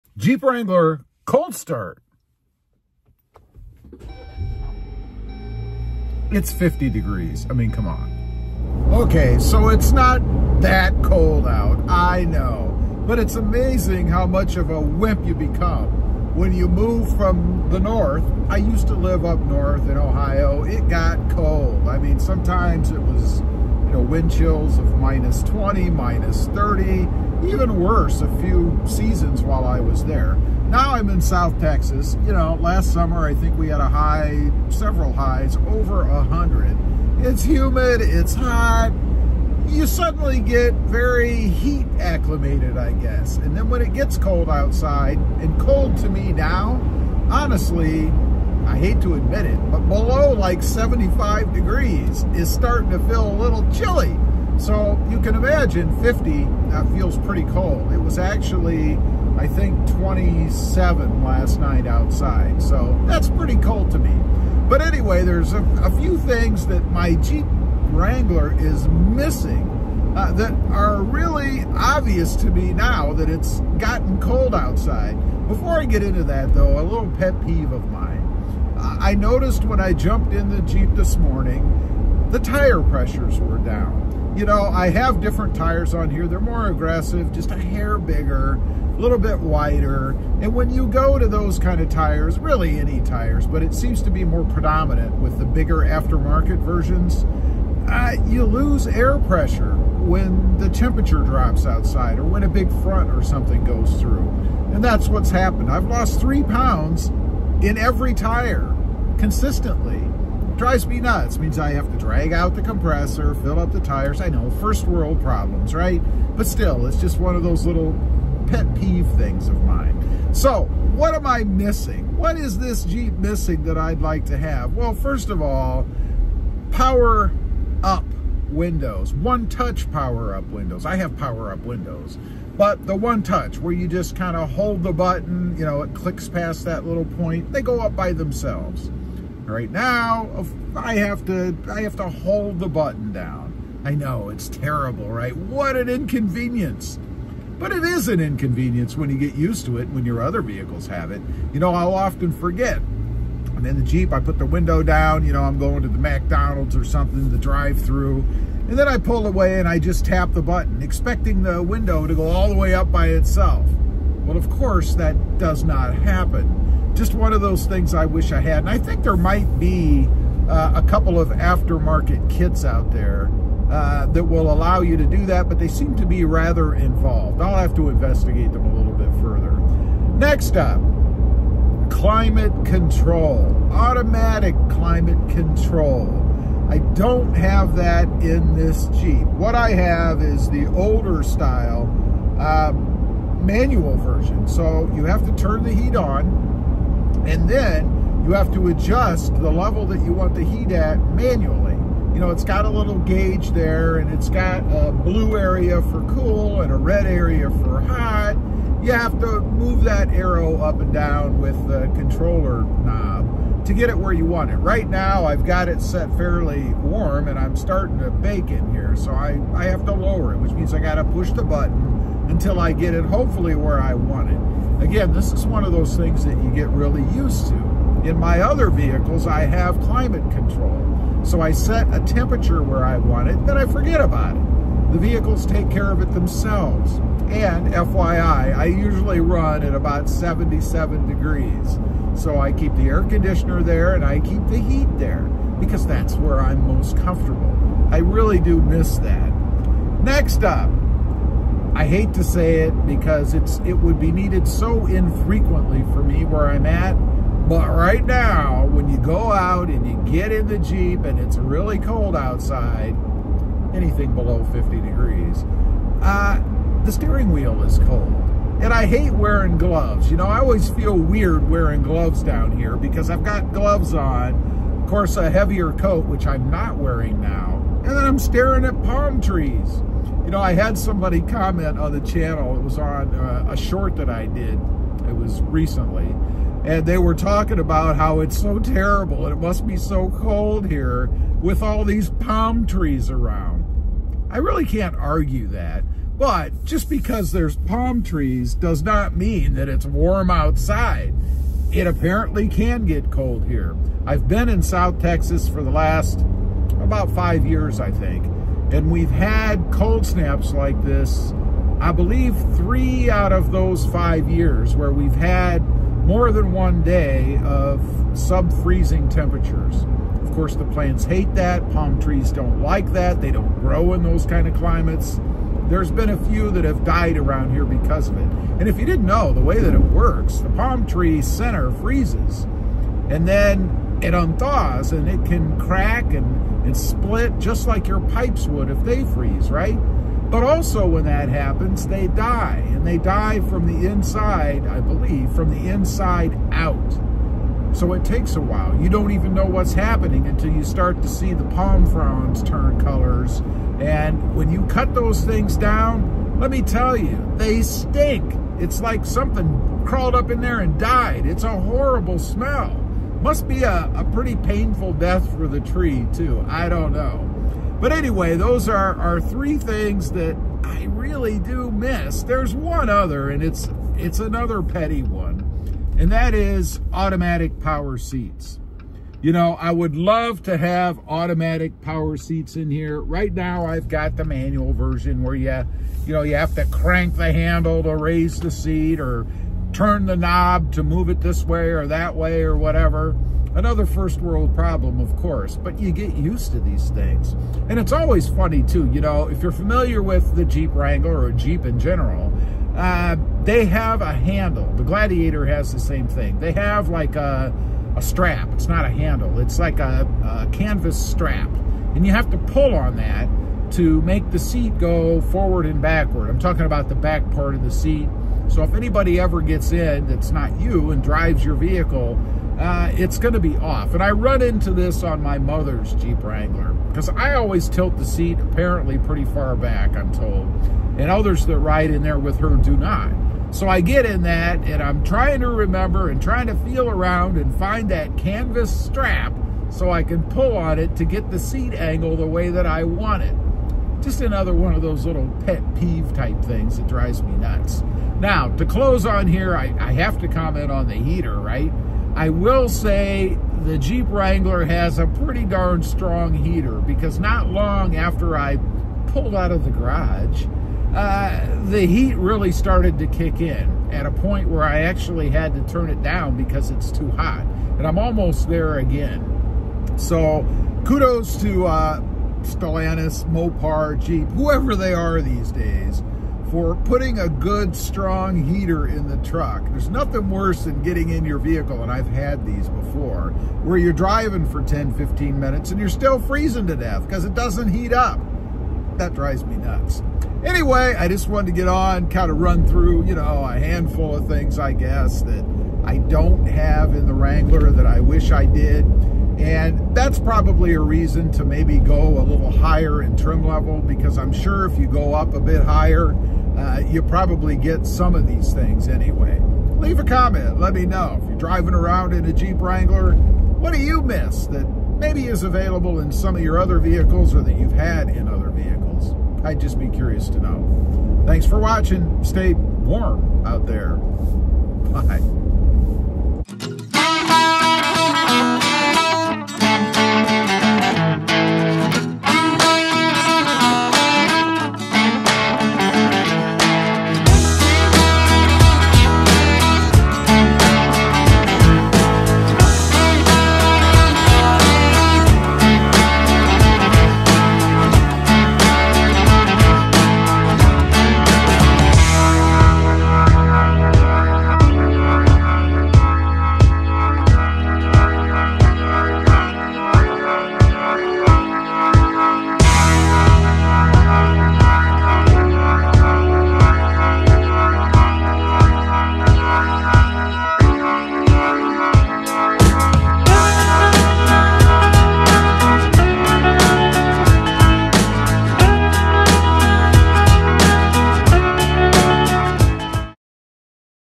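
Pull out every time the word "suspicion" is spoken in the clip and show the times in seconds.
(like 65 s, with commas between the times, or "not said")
not said.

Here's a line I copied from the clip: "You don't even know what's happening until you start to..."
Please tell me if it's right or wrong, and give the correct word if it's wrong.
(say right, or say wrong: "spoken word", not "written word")
right.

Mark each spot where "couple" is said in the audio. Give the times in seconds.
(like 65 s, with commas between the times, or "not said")
170 s.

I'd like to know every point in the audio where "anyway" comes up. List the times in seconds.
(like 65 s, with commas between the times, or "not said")
64 s, 367 s, 490 s, 508 s.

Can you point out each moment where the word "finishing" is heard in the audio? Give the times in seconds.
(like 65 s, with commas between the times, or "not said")
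not said.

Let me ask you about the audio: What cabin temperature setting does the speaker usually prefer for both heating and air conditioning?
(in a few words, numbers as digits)
77 degrees.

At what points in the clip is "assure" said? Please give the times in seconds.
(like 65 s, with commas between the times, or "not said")
not said.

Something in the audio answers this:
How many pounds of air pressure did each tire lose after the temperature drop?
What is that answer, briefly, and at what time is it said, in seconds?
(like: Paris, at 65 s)
3, at 106 s.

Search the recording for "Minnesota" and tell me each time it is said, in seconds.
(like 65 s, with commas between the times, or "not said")
not said.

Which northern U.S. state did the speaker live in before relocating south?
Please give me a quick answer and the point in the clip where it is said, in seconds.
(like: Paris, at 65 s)
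Ohio, at 19 s.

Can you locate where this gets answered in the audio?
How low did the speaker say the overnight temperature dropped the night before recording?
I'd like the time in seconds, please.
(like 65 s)
59 s.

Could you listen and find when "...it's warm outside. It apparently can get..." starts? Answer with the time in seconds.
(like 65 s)
299 s.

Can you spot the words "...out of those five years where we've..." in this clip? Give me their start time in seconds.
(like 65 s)
313 s.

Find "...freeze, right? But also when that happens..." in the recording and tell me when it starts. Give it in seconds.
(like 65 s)
339 s.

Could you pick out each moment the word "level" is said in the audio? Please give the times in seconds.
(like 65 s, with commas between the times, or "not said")
199 s, 503 s.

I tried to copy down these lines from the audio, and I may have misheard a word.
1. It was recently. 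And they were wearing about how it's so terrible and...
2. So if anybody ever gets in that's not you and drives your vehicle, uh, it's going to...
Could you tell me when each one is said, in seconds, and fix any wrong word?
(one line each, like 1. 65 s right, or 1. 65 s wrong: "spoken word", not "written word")
1. 285 s wrong: "talking", not "wearing"
2. 418 s right.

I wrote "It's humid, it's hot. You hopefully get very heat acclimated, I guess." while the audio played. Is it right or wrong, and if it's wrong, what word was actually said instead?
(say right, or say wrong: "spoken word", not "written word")
wrong: "suddenly", not "hopefully".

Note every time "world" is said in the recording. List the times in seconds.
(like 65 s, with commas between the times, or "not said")
114 s, 394 s.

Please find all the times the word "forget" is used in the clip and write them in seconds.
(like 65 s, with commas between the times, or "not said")
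152 s, 233 s.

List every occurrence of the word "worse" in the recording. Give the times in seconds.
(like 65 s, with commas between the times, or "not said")
27 s, 480 s.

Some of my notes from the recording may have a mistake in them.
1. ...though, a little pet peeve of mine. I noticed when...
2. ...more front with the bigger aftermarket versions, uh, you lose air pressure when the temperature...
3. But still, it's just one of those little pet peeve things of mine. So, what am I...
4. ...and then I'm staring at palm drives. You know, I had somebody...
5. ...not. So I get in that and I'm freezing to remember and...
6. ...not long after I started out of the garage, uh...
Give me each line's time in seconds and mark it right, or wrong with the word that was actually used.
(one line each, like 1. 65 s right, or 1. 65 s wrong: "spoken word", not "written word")
1. 76 s right
2. 94 s wrong: "predominant", not "front"
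3. 116 s right
4. 277 s wrong: "trees", not "drives"
5. 432 s wrong: "trying", not "freezing"
6. 457 s wrong: "pulled", not "started".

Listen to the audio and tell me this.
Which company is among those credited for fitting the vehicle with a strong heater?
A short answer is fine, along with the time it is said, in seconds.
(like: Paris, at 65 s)
Stellantis, at 472 s.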